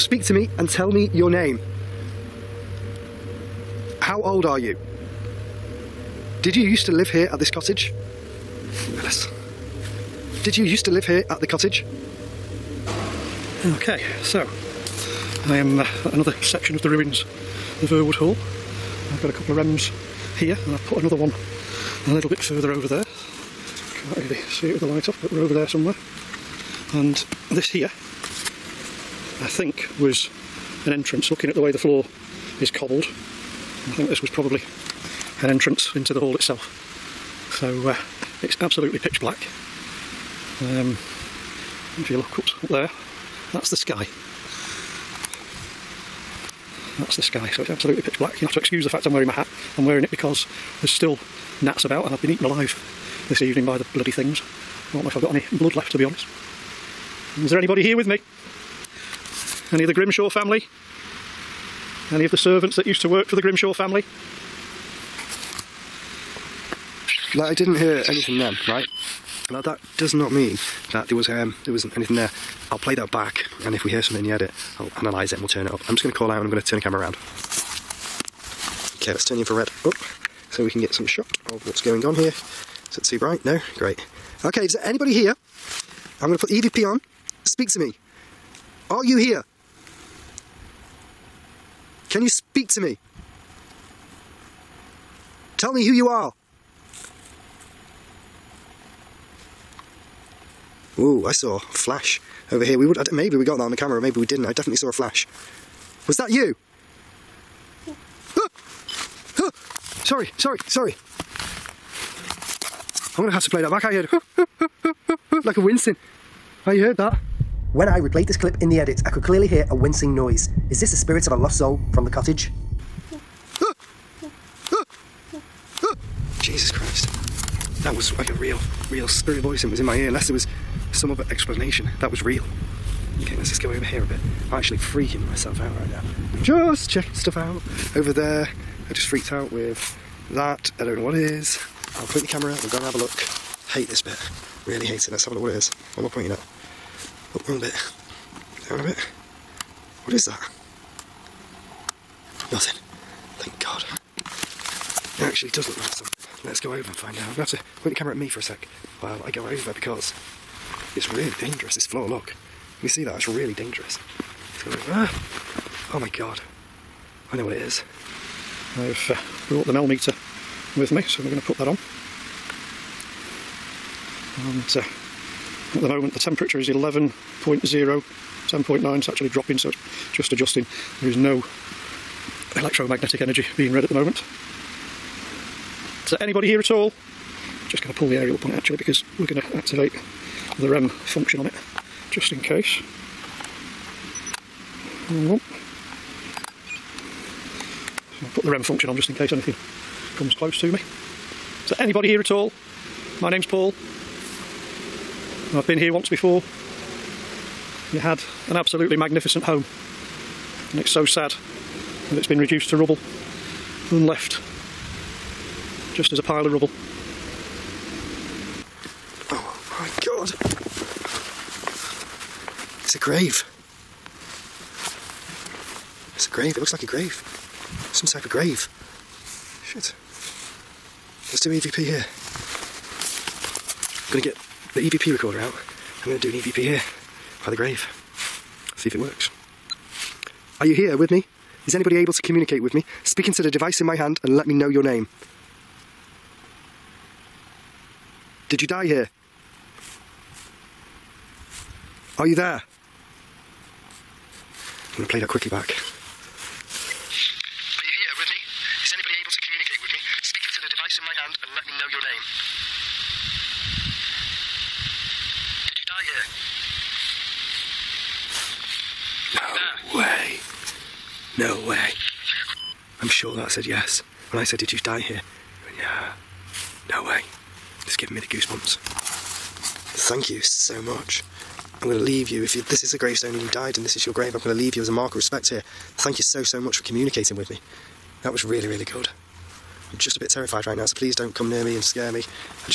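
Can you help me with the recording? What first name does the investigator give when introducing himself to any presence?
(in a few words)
Paul.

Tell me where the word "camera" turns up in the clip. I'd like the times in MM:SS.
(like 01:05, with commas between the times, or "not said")
01:16, 01:43, 02:22, 02:37.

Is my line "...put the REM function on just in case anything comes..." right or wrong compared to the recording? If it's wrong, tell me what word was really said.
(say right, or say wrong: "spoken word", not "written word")
right.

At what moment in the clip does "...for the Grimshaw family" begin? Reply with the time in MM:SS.
01:03.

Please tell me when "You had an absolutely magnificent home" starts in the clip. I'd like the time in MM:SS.
03:27.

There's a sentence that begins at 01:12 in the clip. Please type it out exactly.
I'll play that back, and if we hear something in the edit, I'll analyse it and we'll turn it up.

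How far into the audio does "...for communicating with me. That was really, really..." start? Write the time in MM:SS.
04:46.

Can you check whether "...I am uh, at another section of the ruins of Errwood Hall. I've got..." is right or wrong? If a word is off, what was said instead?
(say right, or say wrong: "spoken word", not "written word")
right.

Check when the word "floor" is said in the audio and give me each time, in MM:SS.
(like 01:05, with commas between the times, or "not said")
00:31, 02:41.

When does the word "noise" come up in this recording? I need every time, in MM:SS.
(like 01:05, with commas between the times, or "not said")
02:00.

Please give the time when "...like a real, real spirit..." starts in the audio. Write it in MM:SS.
02:08.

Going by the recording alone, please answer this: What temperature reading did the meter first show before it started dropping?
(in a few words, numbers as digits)
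11.0.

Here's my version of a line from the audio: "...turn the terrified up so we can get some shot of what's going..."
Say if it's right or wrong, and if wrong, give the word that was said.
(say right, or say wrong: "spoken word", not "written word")
wrong: "infrared", not "terrified".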